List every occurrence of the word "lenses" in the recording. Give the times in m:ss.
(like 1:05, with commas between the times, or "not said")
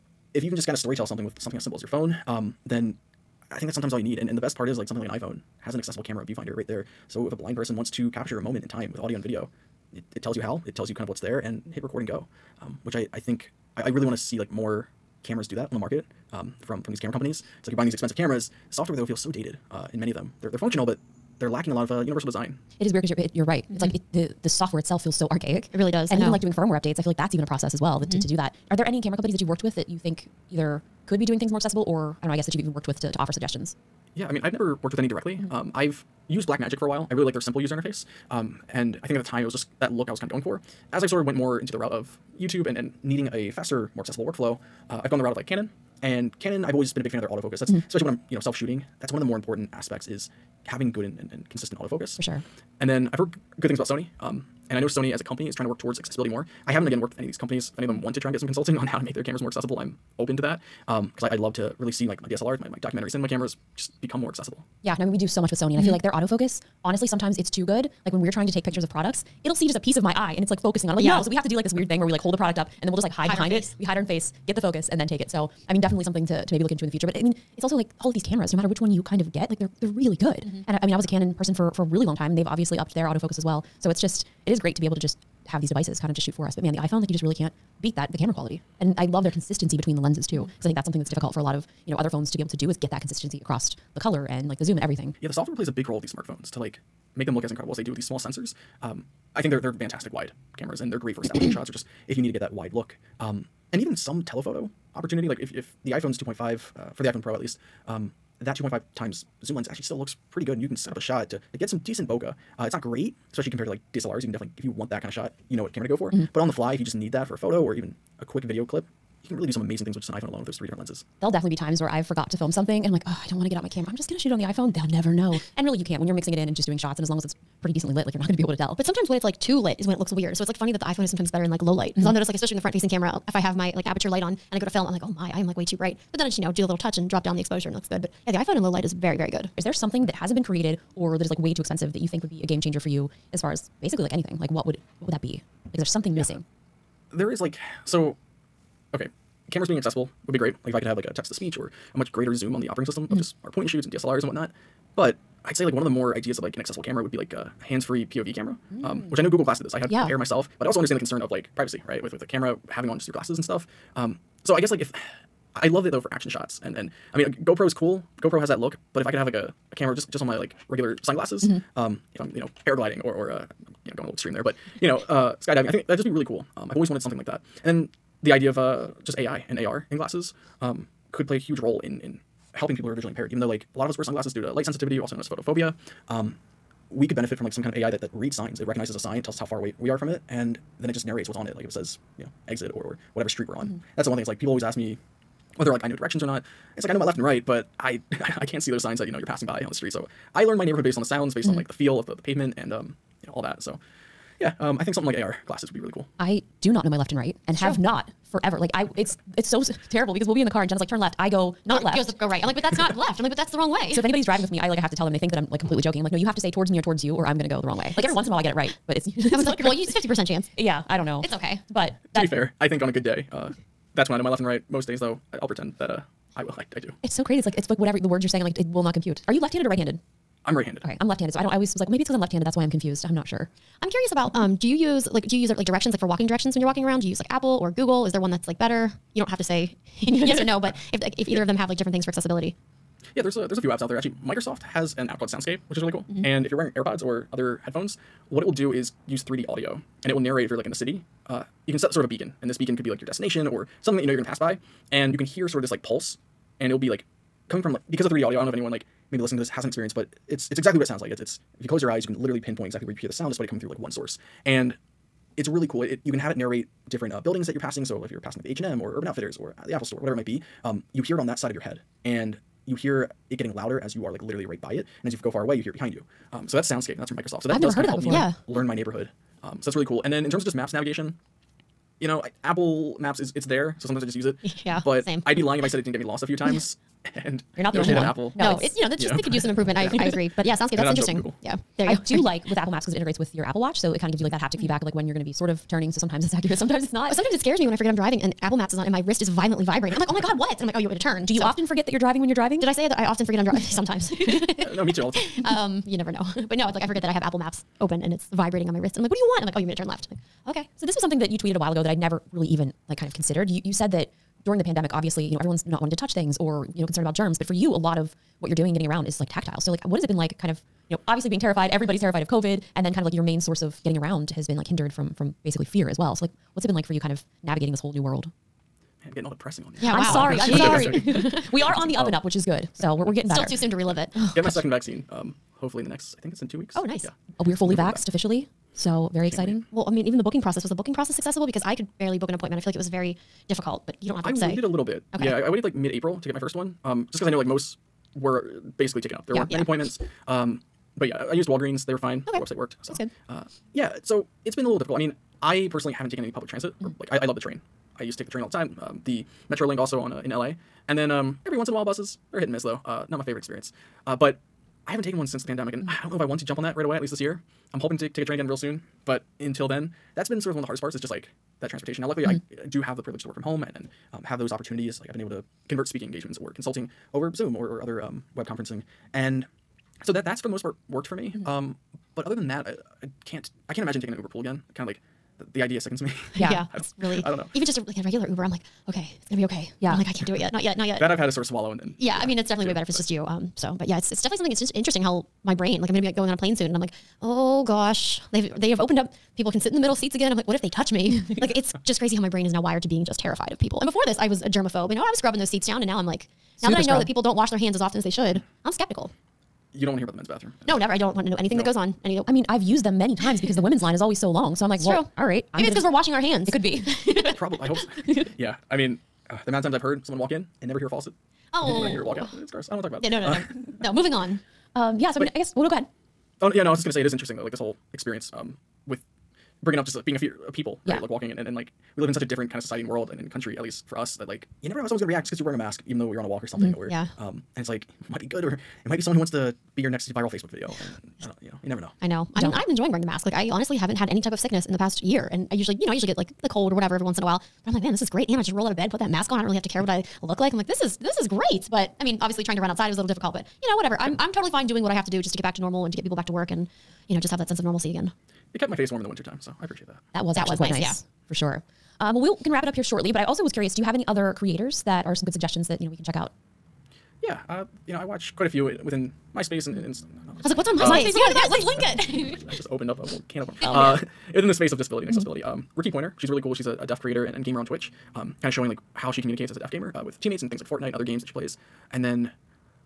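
1:29, 2:00.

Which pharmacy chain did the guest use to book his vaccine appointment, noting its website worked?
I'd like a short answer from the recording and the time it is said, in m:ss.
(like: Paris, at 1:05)
Walgreens, at 5:51.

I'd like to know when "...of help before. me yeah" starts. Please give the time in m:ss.
4:37.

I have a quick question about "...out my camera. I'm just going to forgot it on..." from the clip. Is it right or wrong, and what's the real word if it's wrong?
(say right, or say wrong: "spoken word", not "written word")
wrong: "shoot", not "forgot".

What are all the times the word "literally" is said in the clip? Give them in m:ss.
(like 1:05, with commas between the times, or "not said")
4:22, 4:34.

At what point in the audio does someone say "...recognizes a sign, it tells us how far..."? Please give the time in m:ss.
3:08.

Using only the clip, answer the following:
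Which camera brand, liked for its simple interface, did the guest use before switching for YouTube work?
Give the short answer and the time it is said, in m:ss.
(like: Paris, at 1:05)
Blackmagic, at 0:36.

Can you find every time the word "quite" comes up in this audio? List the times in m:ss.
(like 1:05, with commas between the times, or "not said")
7:40, 7:48.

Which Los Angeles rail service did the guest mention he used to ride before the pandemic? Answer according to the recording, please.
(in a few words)
MetroLink.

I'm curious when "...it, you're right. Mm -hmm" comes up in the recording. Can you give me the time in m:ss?
0:23.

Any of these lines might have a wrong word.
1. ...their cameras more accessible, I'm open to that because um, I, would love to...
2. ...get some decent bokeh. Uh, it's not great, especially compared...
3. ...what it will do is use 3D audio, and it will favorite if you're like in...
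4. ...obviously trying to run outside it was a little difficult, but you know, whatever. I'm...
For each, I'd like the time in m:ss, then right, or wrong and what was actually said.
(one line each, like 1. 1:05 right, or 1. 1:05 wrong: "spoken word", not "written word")
1. 0:59 right
2. 1:51 right
3. 4:08 wrong: "narrate", not "favorite"
4. 7:32 right.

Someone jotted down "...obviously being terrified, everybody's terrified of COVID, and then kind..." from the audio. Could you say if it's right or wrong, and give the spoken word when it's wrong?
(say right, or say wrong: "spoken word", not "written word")
right.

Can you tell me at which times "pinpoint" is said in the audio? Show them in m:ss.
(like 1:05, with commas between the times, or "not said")
4:22.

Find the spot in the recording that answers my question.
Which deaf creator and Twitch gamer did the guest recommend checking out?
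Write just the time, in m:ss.
7:55.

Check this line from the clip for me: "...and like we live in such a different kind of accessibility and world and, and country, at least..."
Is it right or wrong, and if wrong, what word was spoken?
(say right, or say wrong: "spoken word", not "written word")
wrong: "society", not "accessibility".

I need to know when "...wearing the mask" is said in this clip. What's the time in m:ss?
7:22.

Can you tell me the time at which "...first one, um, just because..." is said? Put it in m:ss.
5:46.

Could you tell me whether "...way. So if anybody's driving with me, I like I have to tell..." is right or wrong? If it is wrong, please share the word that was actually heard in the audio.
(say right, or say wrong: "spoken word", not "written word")
right.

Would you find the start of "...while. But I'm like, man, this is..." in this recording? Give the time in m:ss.
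7:27.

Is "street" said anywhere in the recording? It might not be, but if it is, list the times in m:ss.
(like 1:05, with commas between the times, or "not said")
3:13, 3:19.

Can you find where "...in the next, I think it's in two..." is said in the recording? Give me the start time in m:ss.
5:35.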